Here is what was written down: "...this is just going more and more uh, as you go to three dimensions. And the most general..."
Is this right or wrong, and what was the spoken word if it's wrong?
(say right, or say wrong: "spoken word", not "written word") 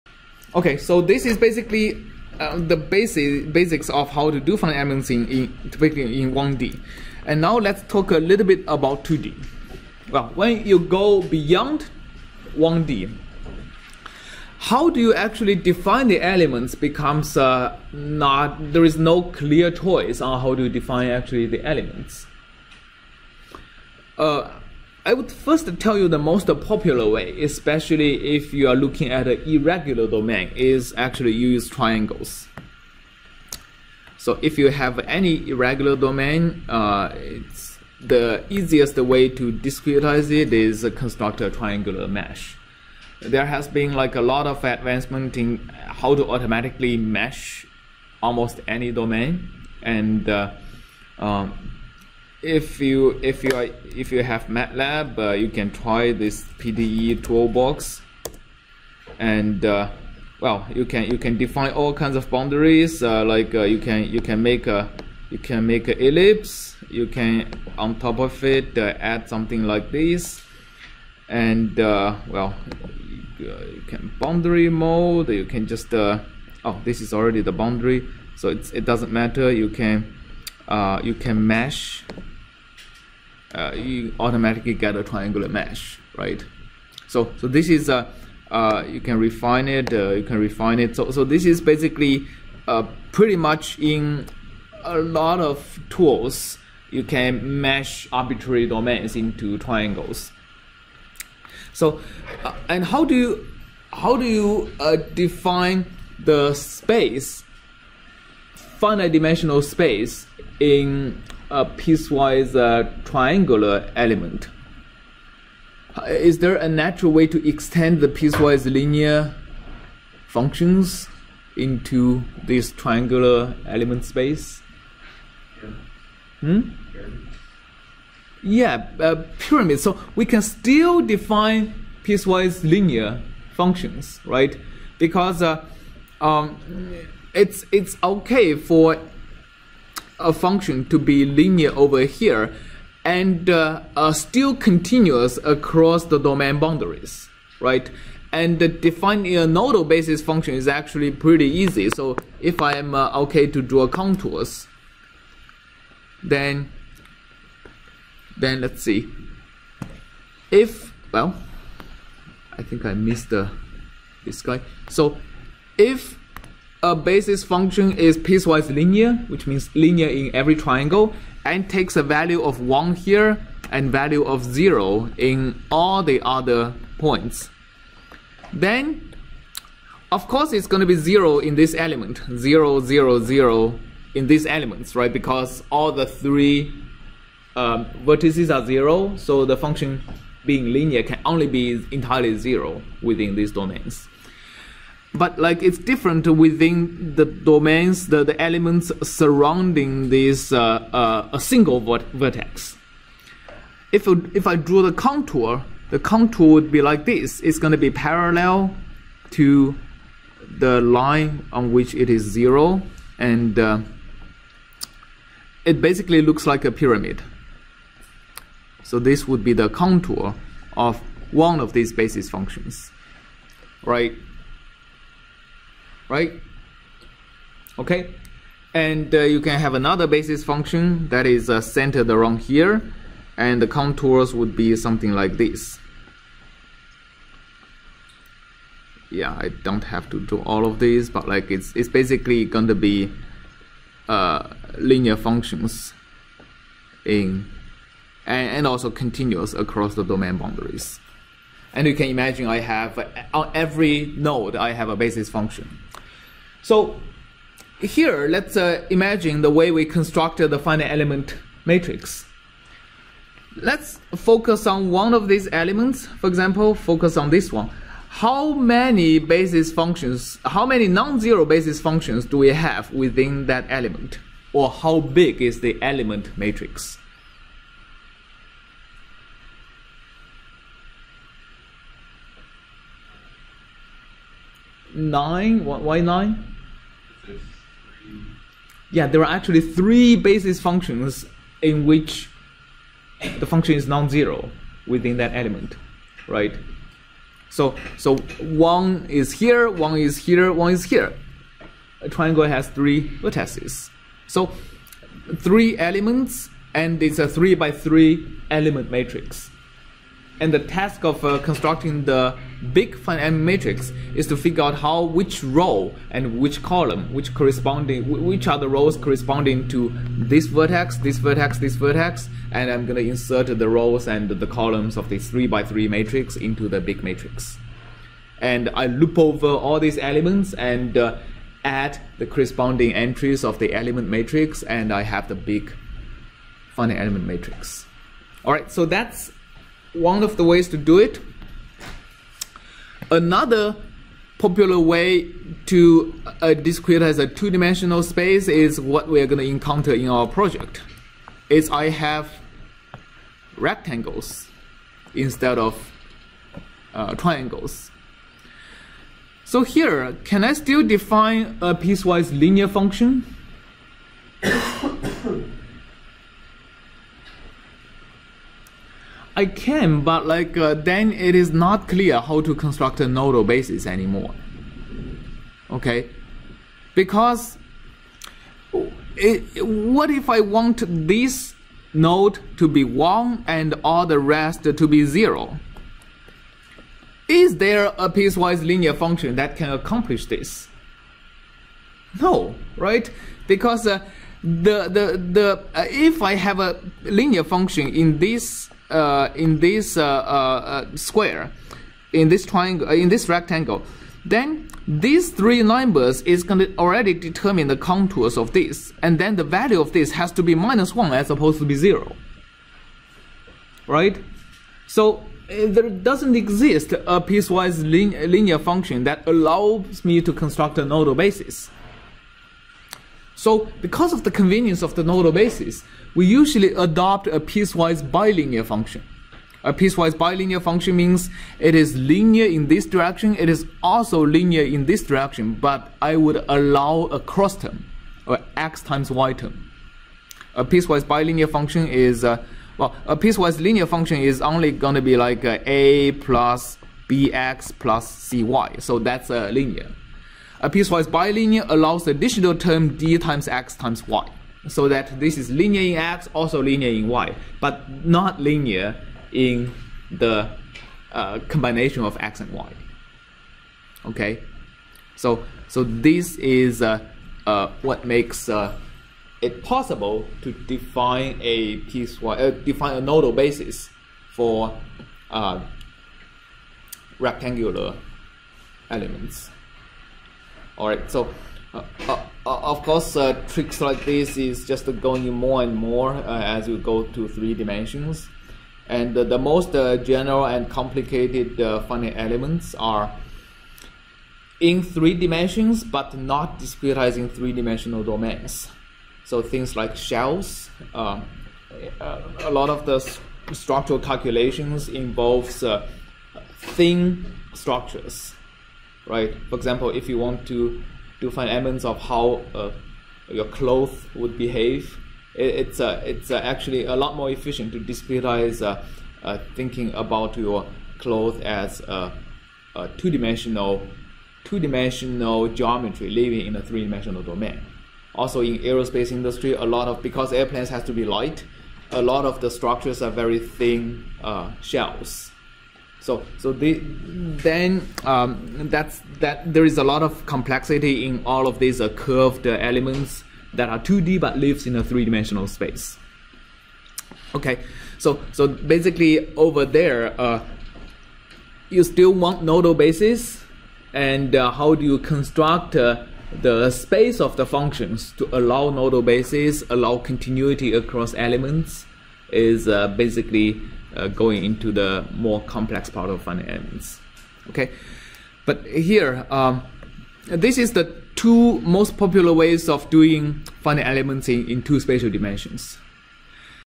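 right.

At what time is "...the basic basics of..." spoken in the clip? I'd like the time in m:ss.
0:02.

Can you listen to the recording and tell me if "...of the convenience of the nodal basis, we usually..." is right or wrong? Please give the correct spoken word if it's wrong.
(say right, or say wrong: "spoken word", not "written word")
right.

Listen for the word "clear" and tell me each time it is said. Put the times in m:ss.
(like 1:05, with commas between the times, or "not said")
0:19, 6:11.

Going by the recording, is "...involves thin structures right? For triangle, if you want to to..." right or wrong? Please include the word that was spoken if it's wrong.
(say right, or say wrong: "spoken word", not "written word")
wrong: "example", not "triangle".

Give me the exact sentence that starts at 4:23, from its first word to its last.
Let's focus on one of these elements.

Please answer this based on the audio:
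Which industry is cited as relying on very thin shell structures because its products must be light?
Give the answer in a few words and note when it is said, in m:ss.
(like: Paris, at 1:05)
Aerospace industry, at 8:48.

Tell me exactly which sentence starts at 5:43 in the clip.
Another popular way to uh, discretize a two-dimensional space is what we are going to encounter in our project.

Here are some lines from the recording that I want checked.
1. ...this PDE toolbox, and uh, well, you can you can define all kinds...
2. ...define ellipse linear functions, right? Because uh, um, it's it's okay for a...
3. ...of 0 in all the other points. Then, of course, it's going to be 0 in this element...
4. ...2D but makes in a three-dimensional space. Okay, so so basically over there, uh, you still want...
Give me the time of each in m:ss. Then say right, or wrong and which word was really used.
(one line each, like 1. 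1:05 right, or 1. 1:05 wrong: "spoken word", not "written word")
1. 0:56 right
2. 2:11 wrong: "piecewise", not "ellipse"
3. 2:54 right
4. 9:03 wrong: "lives", not "makes".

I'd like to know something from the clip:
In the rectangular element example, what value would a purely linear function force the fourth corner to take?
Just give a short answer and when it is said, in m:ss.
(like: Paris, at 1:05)
-1, at 6:50.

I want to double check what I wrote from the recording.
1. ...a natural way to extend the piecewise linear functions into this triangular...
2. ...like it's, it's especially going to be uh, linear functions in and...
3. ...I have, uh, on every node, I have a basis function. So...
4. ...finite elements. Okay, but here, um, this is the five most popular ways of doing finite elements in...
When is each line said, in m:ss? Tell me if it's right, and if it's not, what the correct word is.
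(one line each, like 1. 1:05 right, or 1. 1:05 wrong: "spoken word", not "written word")
1. 1:56 right
2. 4:01 wrong: "basically", not "especially"
3. 4:12 right
4. 9:26 wrong: "two", not "five".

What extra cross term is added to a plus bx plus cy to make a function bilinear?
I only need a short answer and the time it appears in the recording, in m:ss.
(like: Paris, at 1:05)
d times x times y, at 7:32.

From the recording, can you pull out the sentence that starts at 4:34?
Or how big is the element matrix?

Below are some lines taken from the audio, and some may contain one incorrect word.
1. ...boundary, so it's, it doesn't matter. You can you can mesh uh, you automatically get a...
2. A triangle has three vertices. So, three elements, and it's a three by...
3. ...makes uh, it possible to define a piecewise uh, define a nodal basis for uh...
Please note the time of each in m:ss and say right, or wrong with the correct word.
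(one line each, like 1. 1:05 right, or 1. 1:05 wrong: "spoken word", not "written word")
1. 1:17 right
2. 5:02 right
3. 7:48 right.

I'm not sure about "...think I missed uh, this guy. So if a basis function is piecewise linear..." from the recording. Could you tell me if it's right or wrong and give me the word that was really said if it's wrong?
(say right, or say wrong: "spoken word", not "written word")
right.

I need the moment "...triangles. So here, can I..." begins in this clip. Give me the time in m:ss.
5:57.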